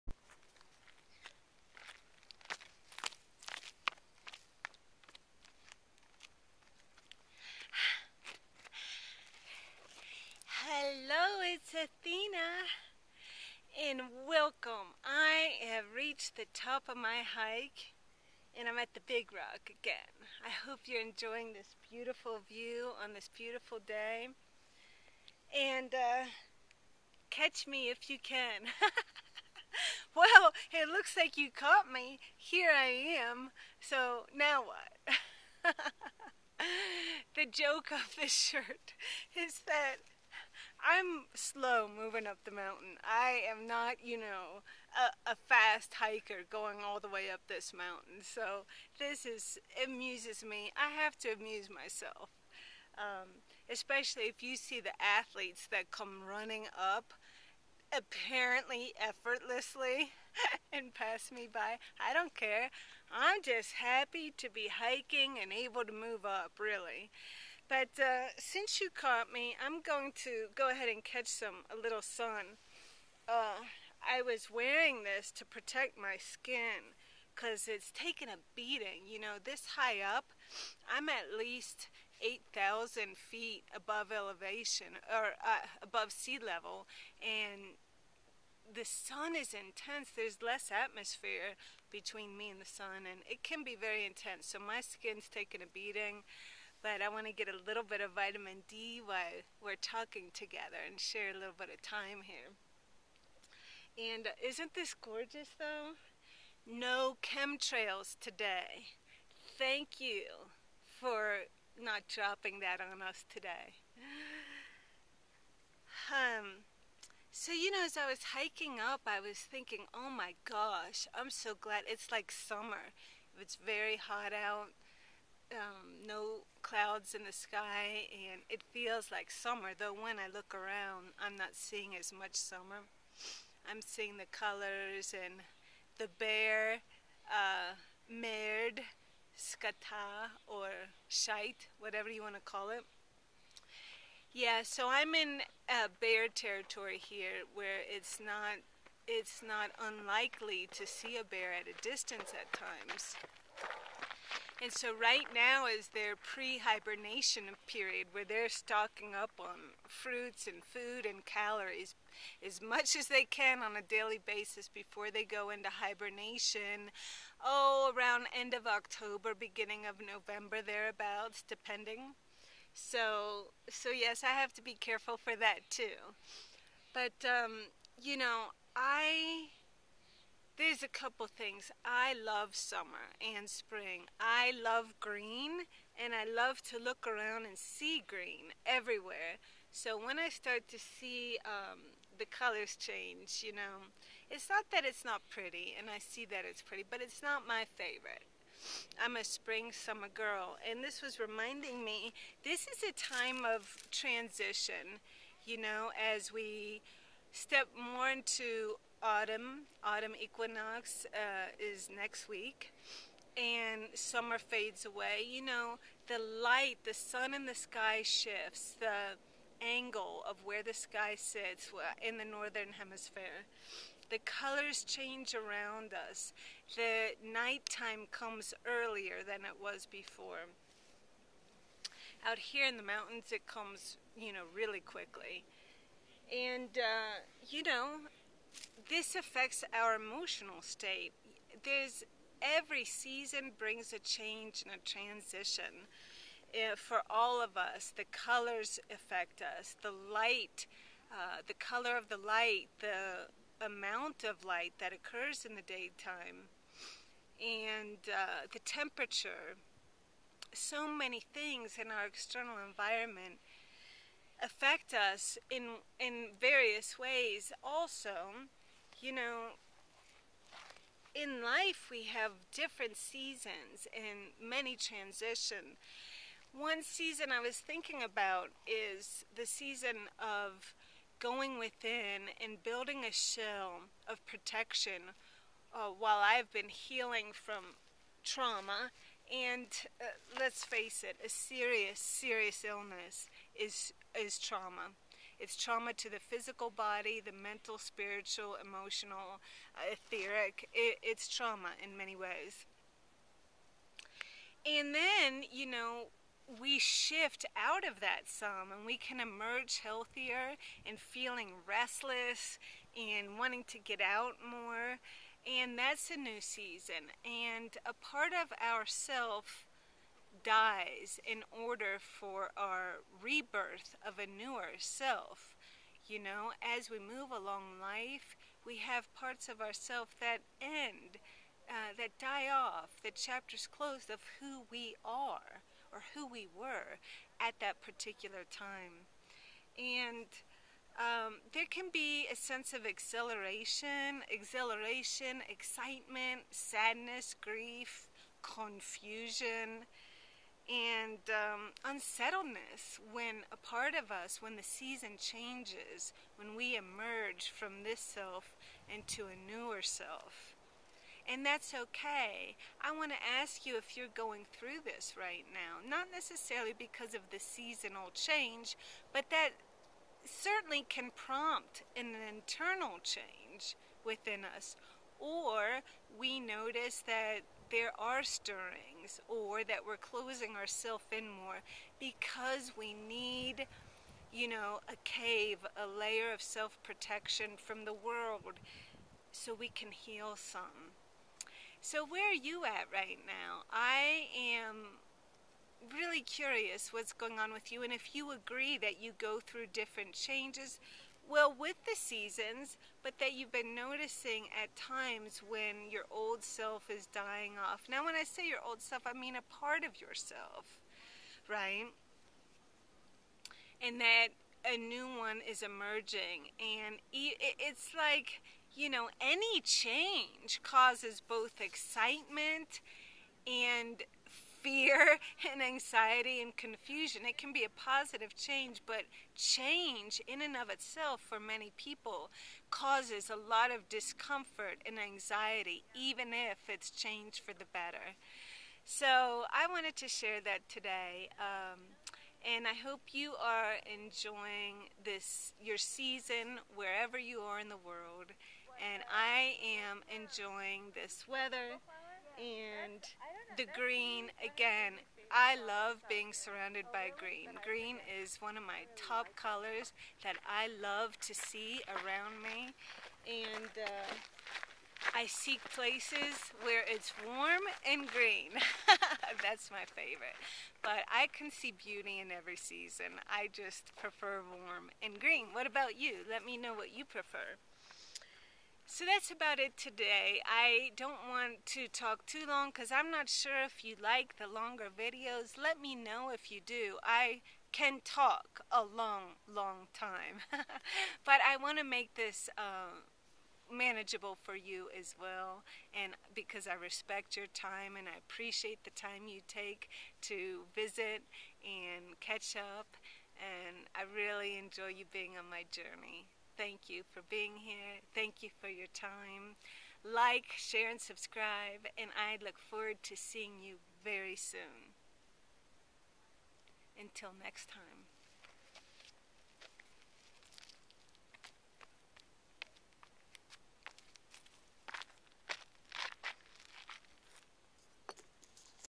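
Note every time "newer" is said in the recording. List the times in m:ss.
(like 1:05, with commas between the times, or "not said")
5:24, 5:59.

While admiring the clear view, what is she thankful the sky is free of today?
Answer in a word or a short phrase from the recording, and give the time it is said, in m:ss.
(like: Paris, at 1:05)
chemtrails, at 1:47.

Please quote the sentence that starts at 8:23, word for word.
And I really enjoy you being on my journey thank you for being here.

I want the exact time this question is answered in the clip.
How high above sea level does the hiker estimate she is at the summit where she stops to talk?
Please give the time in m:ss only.
1:22.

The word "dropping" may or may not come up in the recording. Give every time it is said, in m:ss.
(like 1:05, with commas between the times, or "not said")
1:52.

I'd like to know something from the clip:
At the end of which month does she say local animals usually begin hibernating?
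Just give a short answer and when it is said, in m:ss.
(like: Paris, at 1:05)
October, at 2:48.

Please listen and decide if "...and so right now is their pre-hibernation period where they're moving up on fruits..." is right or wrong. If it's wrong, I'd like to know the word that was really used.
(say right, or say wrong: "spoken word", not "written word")
wrong: "stocking", not "moving".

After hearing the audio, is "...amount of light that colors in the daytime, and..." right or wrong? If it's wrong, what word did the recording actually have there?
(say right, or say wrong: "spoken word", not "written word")
wrong: "occurs", not "colors".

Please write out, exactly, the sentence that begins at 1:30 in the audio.
There's less atmosphere between me and the sun, and it can be very intense.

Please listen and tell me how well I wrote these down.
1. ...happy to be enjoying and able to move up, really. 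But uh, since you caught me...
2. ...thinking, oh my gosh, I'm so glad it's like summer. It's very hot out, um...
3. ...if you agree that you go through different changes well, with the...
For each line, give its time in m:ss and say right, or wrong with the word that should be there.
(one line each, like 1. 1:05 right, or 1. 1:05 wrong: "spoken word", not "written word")
1. 1:03 wrong: "hiking", not "enjoying"
2. 1:59 right
3. 6:37 right.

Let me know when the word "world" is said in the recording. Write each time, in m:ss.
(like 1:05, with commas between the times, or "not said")
6:27, 7:27.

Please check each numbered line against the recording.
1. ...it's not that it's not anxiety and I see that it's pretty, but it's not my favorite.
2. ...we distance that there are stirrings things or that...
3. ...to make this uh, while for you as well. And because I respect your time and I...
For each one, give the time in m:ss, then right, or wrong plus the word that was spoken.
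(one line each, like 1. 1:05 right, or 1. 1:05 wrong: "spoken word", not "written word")
1. 3:14 wrong: "pretty", not "anxiety"
2. 6:16 wrong: "notice", not "distance"
3. 8:11 wrong: "manageable", not "while".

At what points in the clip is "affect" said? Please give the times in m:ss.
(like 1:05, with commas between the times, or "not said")
3:59, 4:08, 4:24.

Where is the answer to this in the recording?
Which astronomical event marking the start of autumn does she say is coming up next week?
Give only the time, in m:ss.
3:29.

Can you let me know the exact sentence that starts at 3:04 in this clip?
I love green and I love to look around and see green everywhere.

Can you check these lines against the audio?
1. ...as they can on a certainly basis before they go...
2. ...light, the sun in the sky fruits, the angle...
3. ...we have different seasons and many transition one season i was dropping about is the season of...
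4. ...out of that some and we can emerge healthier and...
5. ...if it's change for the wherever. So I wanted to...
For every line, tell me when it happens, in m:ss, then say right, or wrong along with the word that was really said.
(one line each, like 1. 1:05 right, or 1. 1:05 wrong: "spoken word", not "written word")
1. 2:42 wrong: "daily", not "certainly"
2. 3:36 wrong: "shifts", not "fruits"
3. 4:31 wrong: "thinking", not "dropping"
4. 5:07 right
5. 7:16 wrong: "better", not "wherever".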